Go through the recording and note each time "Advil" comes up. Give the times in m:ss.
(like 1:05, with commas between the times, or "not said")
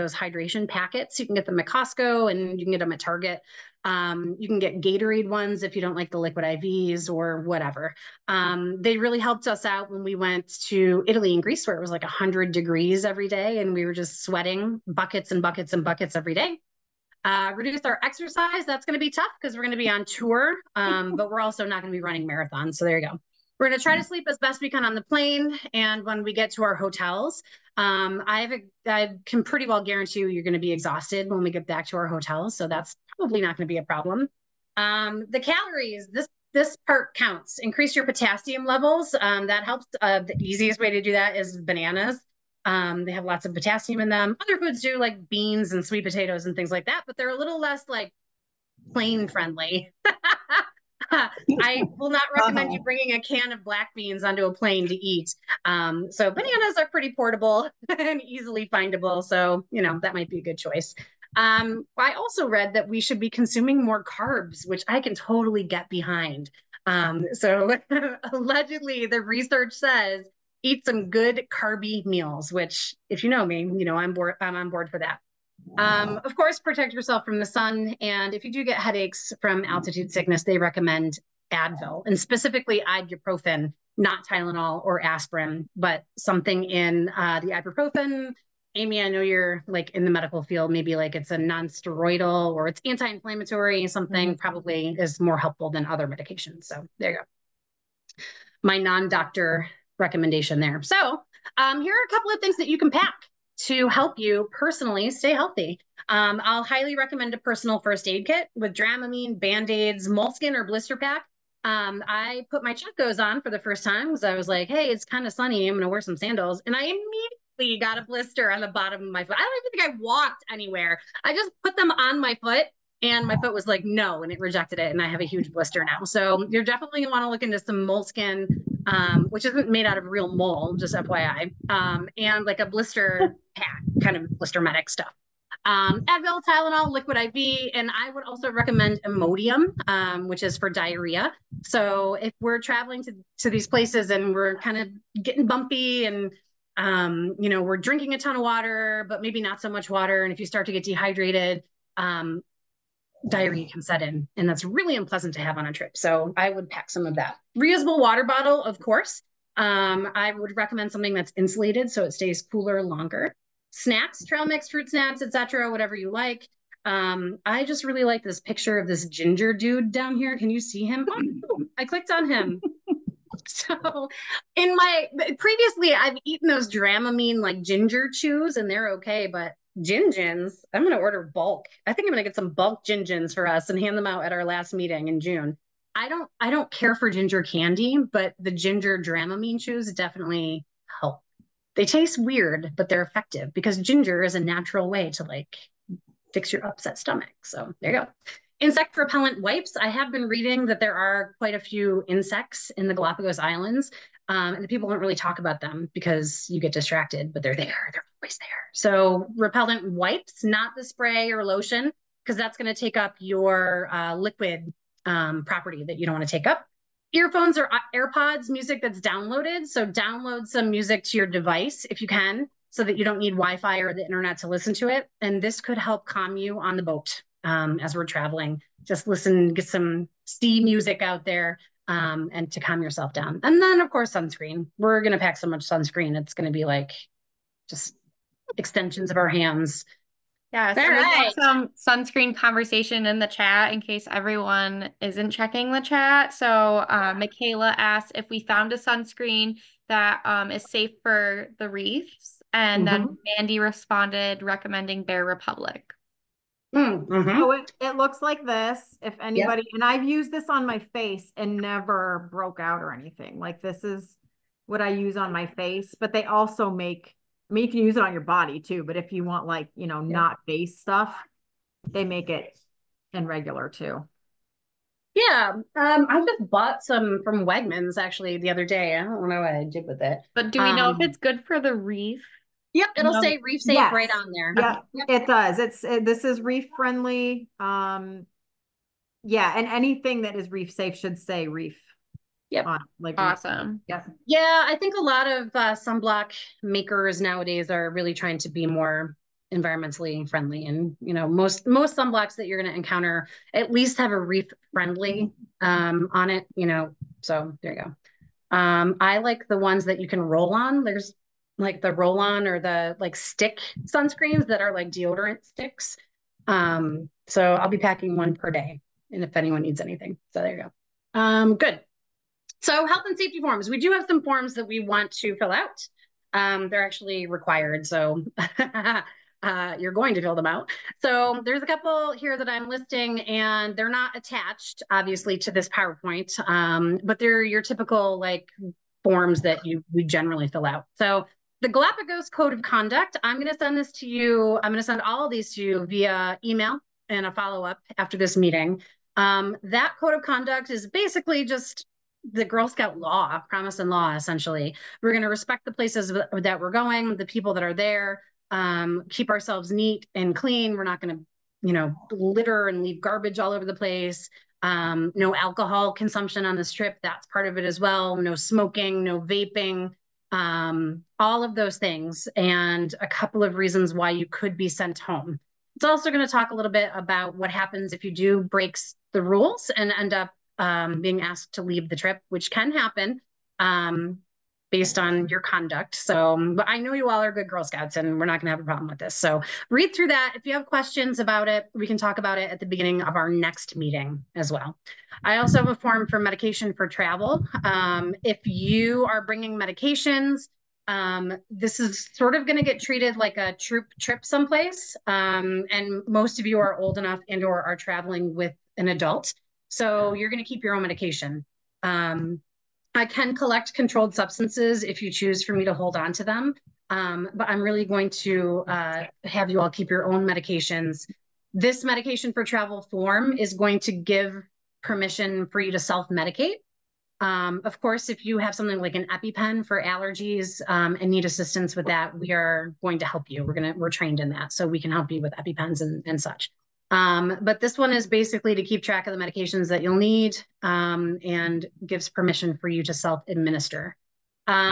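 1:21, 2:16.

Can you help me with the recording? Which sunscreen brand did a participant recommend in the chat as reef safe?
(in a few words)
Bare Republic.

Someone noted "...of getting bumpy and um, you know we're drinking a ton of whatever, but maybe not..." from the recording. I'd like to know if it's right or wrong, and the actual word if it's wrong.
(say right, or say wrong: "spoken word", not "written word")
wrong: "water", not "whatever".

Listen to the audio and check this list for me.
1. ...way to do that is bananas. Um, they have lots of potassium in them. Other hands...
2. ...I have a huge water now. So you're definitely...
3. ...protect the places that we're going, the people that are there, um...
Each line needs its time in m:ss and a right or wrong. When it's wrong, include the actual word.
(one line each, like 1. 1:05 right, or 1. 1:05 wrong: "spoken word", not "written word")
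1. 0:40 wrong: "foods", not "hands"
2. 2:05 wrong: "blister", not "water"
3. 5:55 wrong: "respect", not "protect".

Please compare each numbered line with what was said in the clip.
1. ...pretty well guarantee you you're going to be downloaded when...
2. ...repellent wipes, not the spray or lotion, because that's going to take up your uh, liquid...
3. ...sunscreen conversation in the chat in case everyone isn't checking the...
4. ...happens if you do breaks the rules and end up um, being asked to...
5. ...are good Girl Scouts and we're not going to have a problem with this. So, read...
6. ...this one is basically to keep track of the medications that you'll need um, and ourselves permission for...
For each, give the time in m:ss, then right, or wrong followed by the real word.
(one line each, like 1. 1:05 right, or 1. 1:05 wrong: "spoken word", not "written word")
1. 0:29 wrong: "exhausted", not "downloaded"
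2. 3:29 right
3. 4:01 right
4. 6:17 right
5. 6:27 right
6. 7:17 wrong: "gives", not "ourselves".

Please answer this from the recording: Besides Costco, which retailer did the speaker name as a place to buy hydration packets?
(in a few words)
Target.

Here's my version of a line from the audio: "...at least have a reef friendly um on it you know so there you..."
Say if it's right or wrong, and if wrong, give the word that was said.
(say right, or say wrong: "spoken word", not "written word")
right.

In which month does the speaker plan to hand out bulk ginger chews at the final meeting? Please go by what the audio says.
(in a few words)
June.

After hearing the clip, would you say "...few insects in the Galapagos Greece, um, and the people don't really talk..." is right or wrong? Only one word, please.
wrong.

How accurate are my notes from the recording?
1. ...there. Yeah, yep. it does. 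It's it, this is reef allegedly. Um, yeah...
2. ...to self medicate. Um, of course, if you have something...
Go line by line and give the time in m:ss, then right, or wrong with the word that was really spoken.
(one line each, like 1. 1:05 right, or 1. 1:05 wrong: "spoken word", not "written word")
1. 4:44 wrong: "friendly", not "allegedly"
2. 7:05 right.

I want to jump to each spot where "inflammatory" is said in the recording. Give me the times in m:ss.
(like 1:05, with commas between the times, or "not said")
1:32.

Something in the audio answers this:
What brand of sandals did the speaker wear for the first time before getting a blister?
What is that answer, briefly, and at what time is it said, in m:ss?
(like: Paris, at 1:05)
Chacos, at 1:52.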